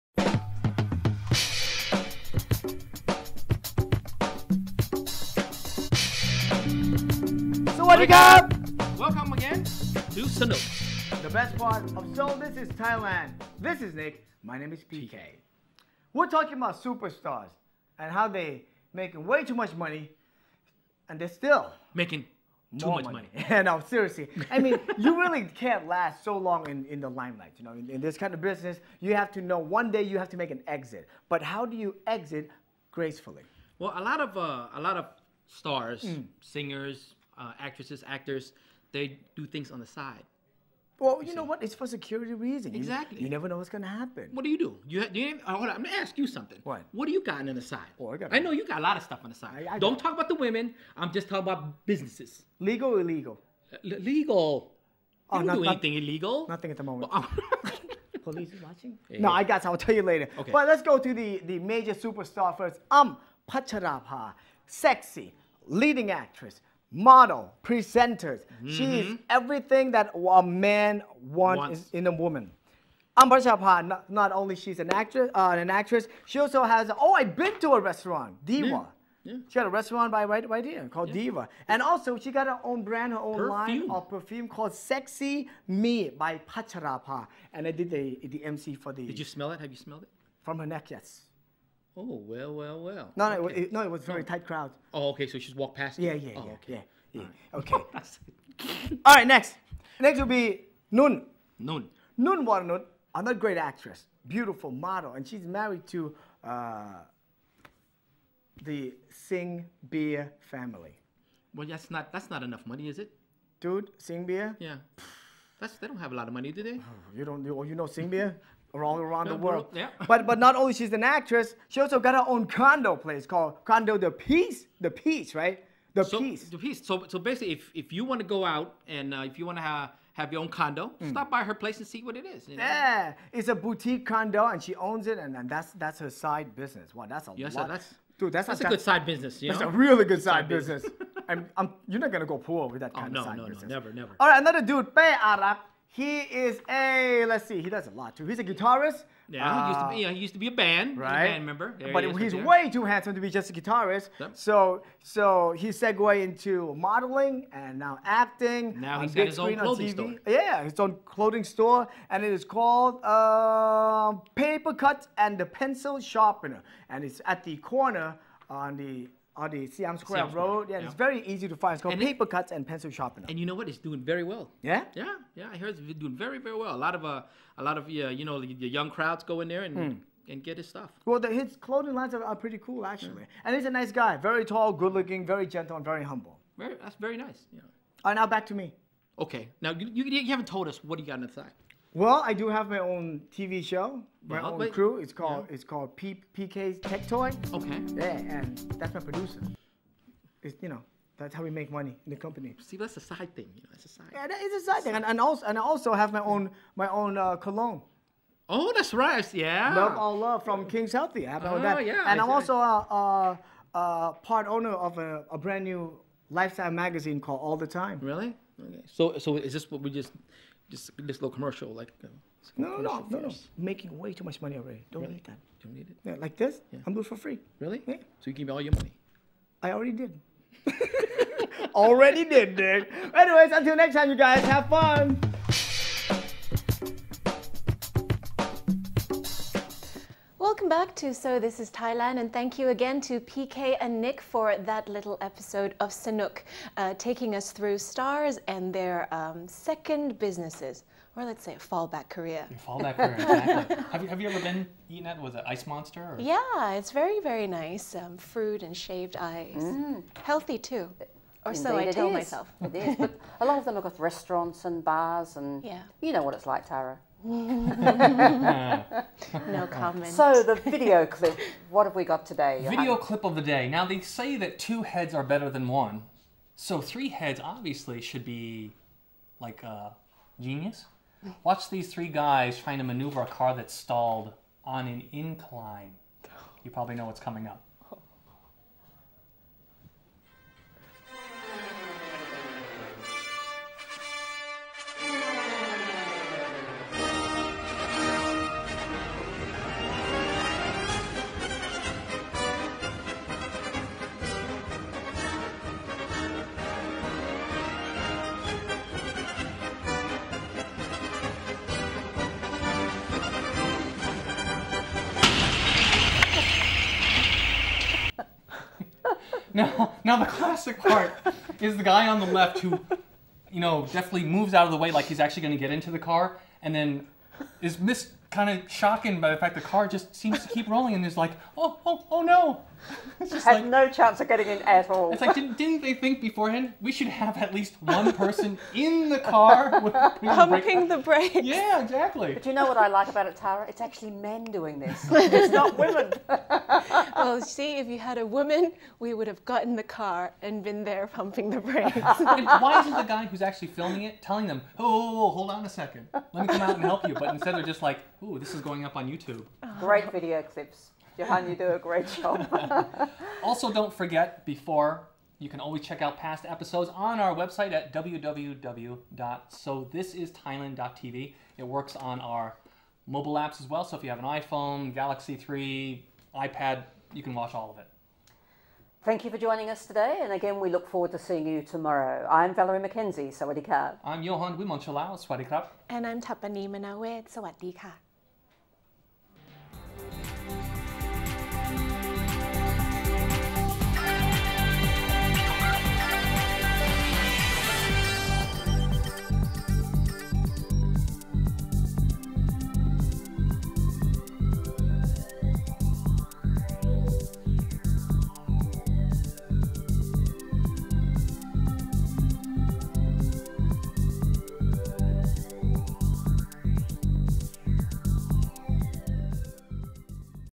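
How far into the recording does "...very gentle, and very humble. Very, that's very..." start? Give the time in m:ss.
3:05.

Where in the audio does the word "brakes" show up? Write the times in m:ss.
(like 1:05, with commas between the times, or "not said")
5:40, 5:51.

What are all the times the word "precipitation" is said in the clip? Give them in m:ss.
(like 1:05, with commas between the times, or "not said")
not said.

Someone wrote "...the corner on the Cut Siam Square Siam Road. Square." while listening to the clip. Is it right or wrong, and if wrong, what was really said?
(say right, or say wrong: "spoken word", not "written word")
wrong: "Audi", not "Cut".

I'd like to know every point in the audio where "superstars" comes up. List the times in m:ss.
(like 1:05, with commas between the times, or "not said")
0:16, 1:01.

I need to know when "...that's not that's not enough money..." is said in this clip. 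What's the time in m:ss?
1:51.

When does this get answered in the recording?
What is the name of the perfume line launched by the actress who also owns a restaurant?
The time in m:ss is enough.
1:24.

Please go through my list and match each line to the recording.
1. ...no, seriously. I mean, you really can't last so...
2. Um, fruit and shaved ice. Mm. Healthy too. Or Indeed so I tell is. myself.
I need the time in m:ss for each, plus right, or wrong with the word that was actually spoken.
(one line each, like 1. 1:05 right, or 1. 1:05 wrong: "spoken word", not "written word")
1. 0:23 right
2. 4:17 right.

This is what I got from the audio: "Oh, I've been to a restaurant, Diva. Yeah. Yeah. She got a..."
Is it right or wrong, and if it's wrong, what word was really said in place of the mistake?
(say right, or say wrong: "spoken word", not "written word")
right.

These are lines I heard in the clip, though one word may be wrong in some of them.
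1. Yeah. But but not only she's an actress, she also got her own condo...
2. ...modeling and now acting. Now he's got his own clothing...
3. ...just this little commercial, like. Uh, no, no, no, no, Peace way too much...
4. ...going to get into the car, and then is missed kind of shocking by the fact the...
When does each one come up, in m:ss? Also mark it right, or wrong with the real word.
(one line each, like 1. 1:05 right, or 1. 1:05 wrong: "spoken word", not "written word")
1. 1:59 right
2. 2:36 right
3. 3:40 wrong: "Making", not "Peace"
4. 5:25 right.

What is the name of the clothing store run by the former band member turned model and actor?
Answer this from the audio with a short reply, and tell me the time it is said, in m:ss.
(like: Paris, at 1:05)
Paper Cut and the Pencil Sharpener, at 2:44.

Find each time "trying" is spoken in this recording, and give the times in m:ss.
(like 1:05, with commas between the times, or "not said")
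4:42.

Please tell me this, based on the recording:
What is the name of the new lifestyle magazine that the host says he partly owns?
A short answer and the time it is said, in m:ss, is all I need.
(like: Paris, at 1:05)
All the Time, at 3:37.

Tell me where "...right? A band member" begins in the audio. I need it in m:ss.
2:30.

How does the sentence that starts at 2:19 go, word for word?
a really good side, side business.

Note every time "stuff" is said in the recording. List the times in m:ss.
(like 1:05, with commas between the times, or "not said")
0:49, 3:00.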